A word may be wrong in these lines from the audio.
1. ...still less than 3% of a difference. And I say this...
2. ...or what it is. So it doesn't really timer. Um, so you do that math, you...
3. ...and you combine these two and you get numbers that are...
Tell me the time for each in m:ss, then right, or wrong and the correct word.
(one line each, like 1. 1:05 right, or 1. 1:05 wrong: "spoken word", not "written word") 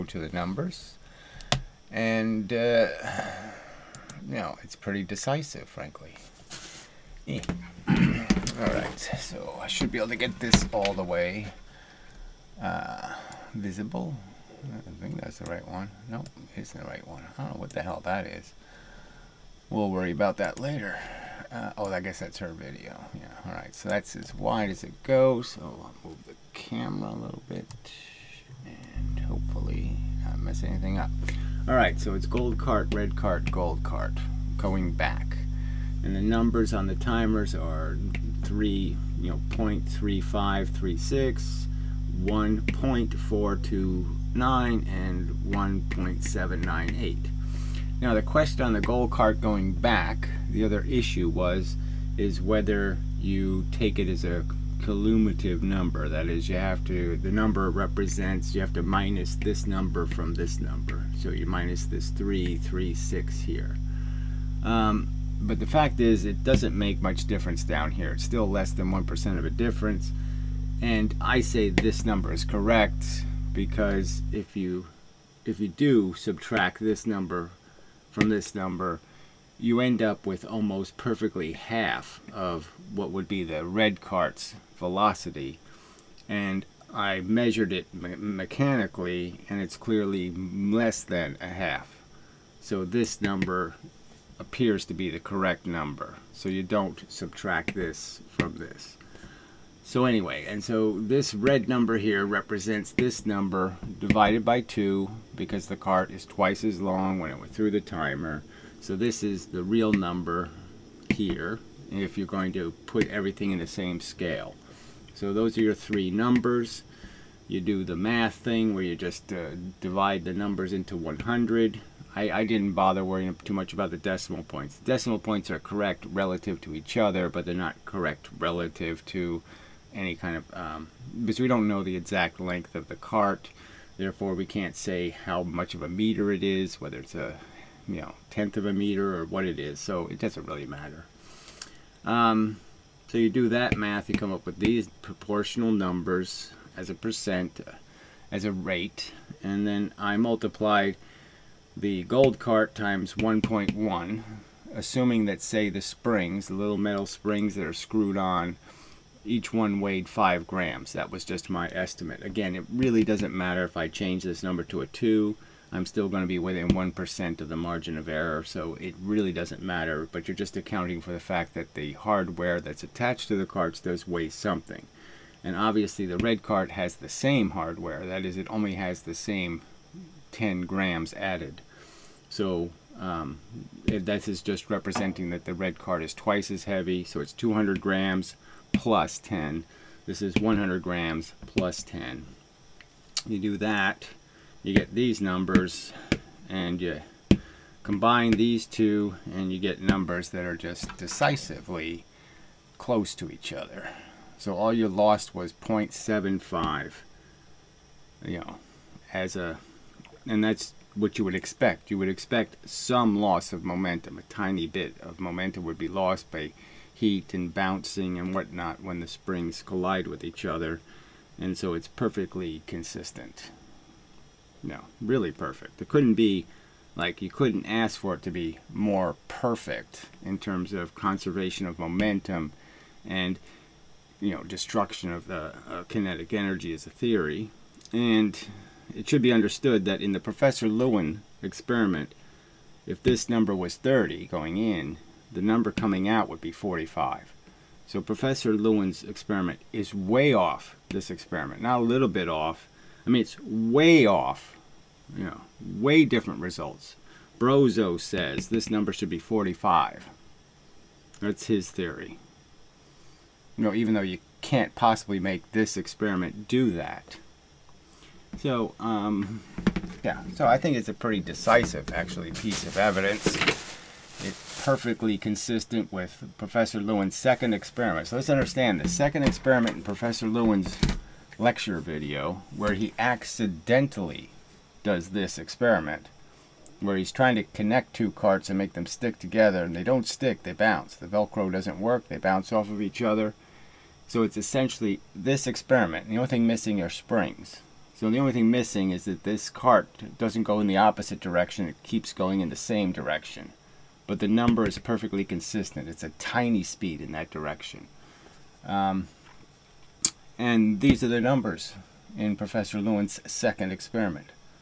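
1. 1:08 wrong: "1", not "3"
2. 2:19 wrong: "matter", not "timer"
3. 3:16 right.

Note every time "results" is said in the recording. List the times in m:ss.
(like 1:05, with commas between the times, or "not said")
4:16.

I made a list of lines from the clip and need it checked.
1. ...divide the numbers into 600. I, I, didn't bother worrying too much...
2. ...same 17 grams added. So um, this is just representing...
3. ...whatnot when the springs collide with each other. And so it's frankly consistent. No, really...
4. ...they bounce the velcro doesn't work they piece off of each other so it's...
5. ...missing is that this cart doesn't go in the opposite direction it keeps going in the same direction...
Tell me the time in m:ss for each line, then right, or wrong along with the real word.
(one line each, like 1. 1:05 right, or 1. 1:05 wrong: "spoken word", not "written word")
1. 1:59 wrong: "100", not "600"
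2. 2:59 wrong: "10", not "17"
3. 3:38 wrong: "perfectly", not "frankly"
4. 4:50 wrong: "bounce", not "piece"
5. 4:58 right.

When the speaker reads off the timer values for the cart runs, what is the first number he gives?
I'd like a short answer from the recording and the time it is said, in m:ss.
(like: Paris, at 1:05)
0.3536, at 0:39.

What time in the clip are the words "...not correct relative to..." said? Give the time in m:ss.
2:07.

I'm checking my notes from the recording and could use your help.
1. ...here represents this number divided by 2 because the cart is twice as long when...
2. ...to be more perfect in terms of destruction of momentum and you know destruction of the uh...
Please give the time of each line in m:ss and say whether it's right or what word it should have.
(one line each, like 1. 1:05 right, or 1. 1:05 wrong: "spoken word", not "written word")
1. 1:41 right
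2. 3:48 wrong: "conservation", not "destruction".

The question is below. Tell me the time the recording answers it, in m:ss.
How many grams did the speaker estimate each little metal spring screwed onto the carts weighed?
2:40.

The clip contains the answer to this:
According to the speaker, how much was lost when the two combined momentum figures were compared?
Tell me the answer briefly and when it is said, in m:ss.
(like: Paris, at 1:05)
0.75, at 3:25.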